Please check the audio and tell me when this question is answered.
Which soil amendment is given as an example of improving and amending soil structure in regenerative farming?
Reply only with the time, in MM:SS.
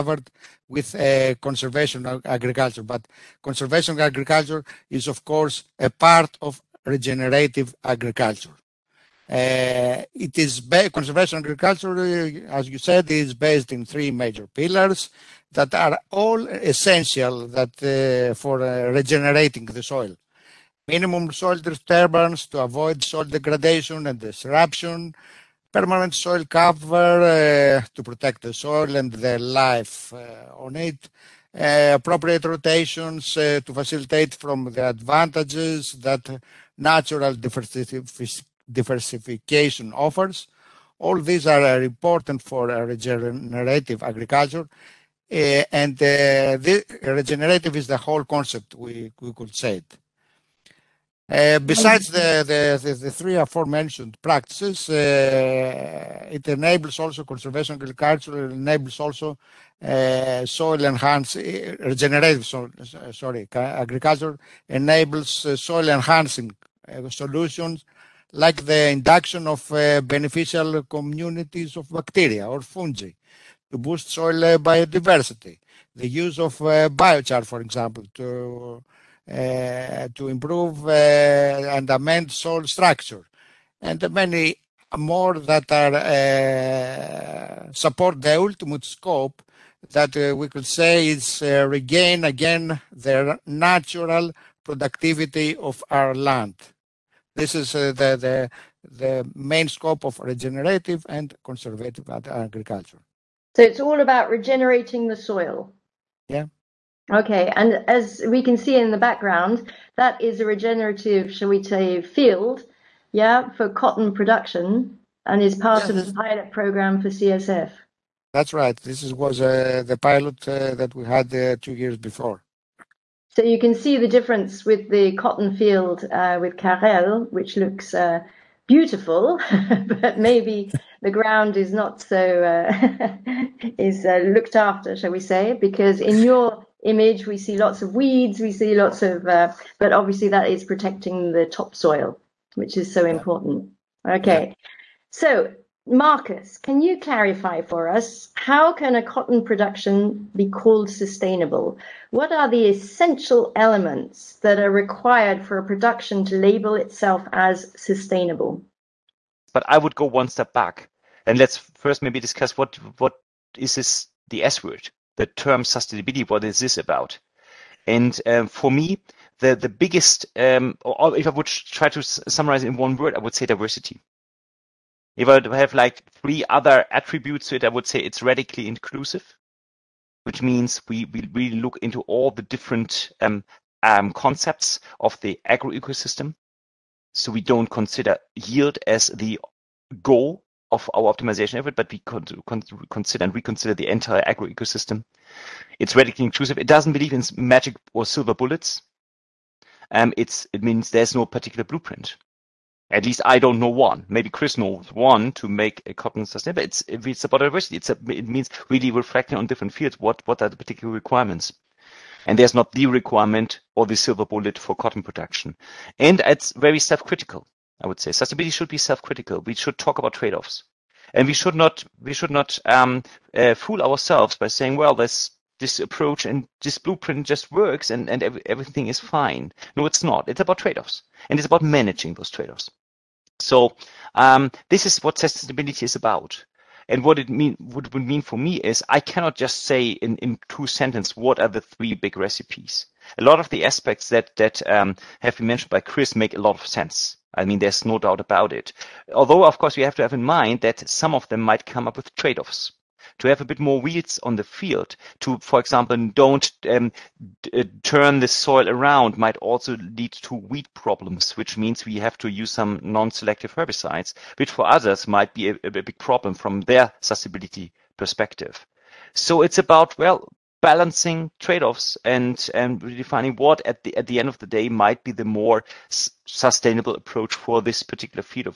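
01:16.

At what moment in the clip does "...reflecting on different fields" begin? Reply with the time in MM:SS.
03:28.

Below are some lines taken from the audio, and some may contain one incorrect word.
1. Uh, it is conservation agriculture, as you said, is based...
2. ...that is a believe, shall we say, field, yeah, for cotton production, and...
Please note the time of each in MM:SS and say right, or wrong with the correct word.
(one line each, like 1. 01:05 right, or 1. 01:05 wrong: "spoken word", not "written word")
1. 00:09 right
2. 01:49 wrong: "regenerative", not "believe".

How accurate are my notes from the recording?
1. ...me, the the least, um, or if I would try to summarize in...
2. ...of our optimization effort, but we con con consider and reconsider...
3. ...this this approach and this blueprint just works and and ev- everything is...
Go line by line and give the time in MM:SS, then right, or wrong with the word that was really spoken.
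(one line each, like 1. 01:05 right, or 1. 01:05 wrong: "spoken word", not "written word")
1. 02:48 wrong: "biggest", not "least"
2. 03:10 right
3. 03:44 right.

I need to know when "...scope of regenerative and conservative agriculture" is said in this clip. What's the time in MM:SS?
01:39.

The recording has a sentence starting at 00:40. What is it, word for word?
All these are uh, important for uh, regenerative agriculture.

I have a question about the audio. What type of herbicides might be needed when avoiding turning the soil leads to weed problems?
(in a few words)
Non-selective herbicides.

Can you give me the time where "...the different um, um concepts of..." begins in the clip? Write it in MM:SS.
03:02.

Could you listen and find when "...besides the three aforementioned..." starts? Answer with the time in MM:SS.
00:51.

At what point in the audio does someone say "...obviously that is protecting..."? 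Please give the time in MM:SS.
02:19.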